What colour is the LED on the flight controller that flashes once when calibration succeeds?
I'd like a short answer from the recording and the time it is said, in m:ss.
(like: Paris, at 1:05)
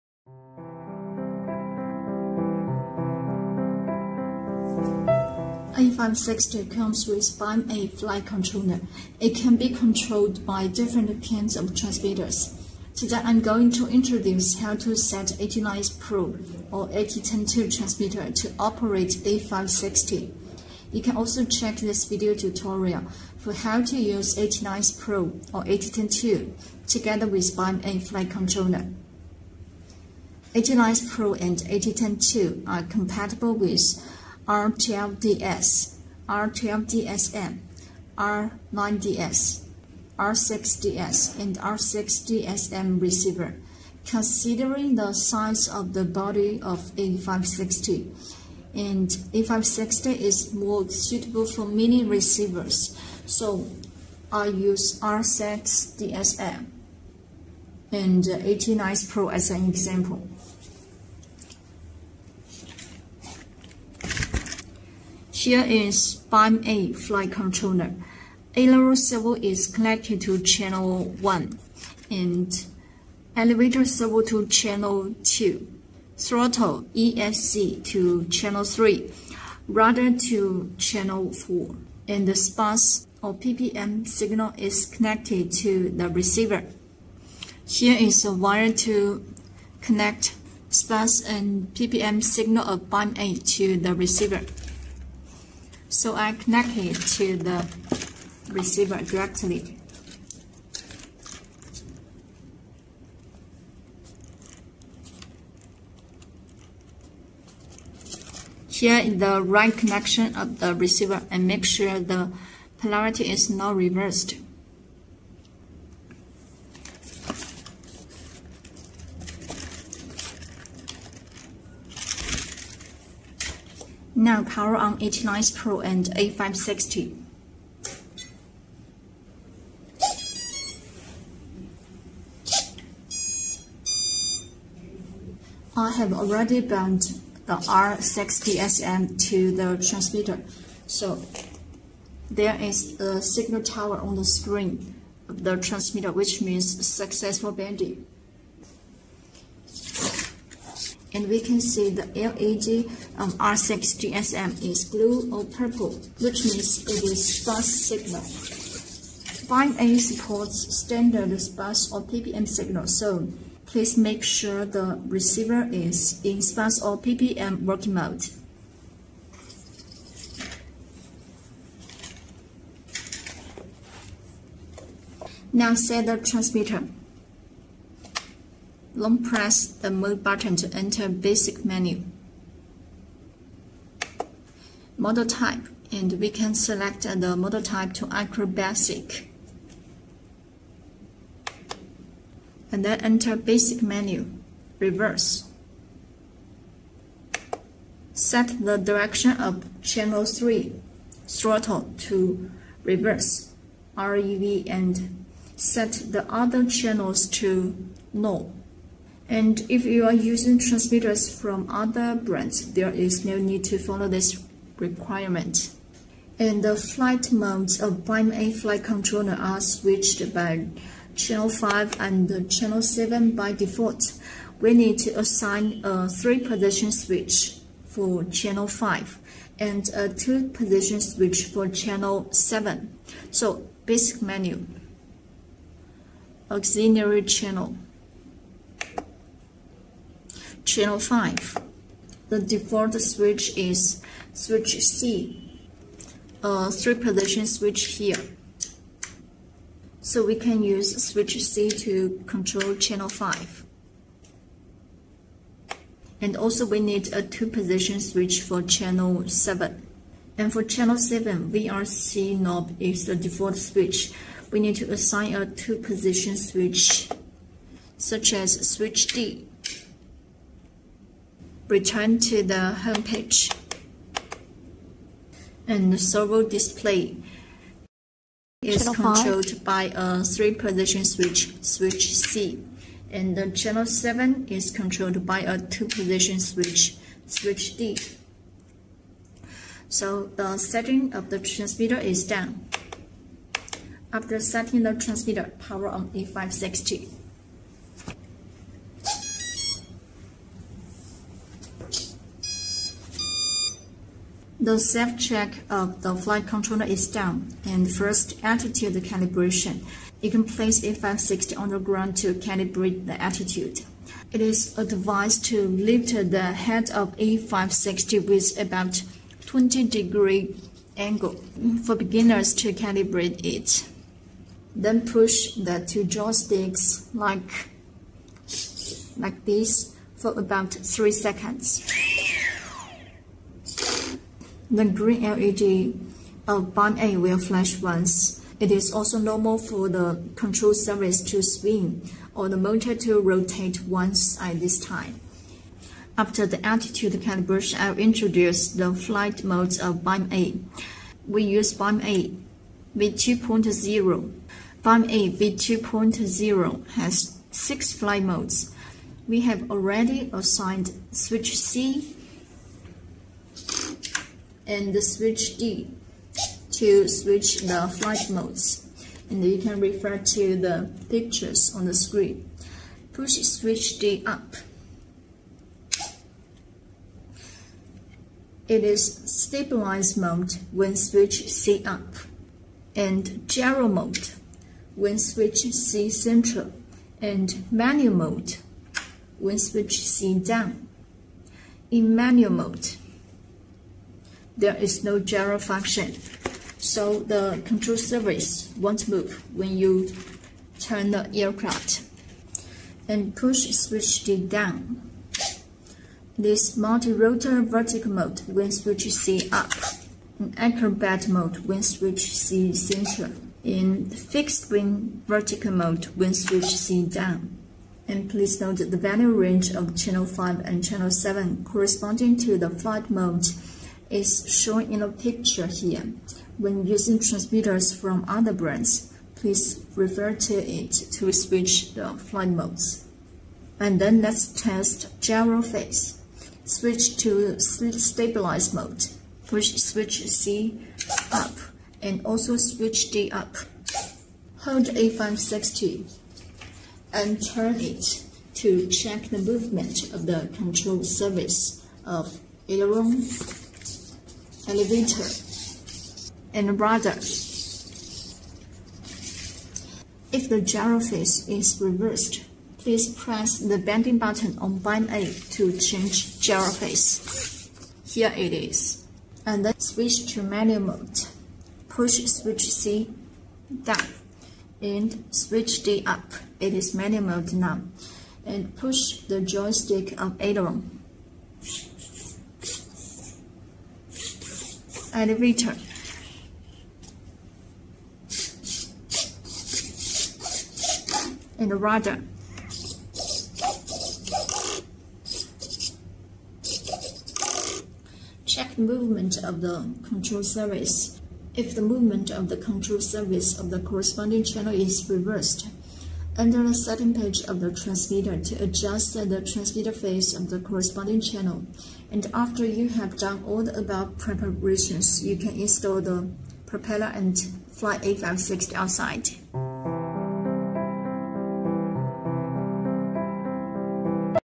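green, at 5:34.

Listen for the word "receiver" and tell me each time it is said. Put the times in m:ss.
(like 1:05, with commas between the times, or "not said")
0:43, 0:52, 1:26, 1:33, 1:38, 1:50, 2:45.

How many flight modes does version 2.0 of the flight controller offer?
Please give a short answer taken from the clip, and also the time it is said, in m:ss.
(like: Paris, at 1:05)
6, at 5:57.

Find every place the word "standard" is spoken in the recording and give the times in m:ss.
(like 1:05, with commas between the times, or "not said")
2:40.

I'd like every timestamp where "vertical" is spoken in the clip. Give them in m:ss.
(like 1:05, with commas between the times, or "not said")
6:47, 6:55.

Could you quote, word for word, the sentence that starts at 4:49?
So the setting of the transmitter is done.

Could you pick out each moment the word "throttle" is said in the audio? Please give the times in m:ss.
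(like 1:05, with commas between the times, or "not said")
1:16, 3:21.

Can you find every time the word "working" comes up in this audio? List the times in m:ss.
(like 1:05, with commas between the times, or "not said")
2:47.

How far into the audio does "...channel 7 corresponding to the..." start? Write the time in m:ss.
7:00.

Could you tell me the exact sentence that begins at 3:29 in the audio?
And if you are using transmitters from other brands, there is no need to follow this requirement.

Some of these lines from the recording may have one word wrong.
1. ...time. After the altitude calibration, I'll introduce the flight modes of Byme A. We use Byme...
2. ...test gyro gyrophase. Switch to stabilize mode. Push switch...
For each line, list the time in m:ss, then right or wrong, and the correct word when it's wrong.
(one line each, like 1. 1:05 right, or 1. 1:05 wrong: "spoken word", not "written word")
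1. 5:44 right
2. 7:14 wrong: "phase", not "gyrophase".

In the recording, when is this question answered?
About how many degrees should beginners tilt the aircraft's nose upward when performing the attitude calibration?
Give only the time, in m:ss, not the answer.
5:19.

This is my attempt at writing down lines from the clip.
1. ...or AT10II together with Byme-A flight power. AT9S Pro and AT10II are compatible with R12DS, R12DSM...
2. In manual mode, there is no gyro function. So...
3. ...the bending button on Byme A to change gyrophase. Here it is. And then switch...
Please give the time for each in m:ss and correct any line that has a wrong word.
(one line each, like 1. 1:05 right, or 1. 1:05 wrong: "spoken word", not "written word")
1. 0:25 wrong: "controller", not "power"
2. 6:31 right
3. 7:43 right.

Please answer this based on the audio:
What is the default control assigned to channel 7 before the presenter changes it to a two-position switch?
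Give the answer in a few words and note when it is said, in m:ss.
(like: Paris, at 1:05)
VRC knob, at 4:21.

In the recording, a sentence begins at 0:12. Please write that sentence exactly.
Today I'm going to introduce how to set AT9S Pro or AT10II transmitter to operate A560.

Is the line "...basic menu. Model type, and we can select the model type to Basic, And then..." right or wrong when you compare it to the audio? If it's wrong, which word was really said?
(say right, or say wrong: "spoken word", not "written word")
right.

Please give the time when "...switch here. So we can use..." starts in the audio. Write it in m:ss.
4:07.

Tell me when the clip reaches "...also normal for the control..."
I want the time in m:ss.
5:38.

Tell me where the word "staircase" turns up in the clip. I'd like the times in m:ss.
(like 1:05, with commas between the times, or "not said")
not said.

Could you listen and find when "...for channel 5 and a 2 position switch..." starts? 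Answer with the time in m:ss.
3:47.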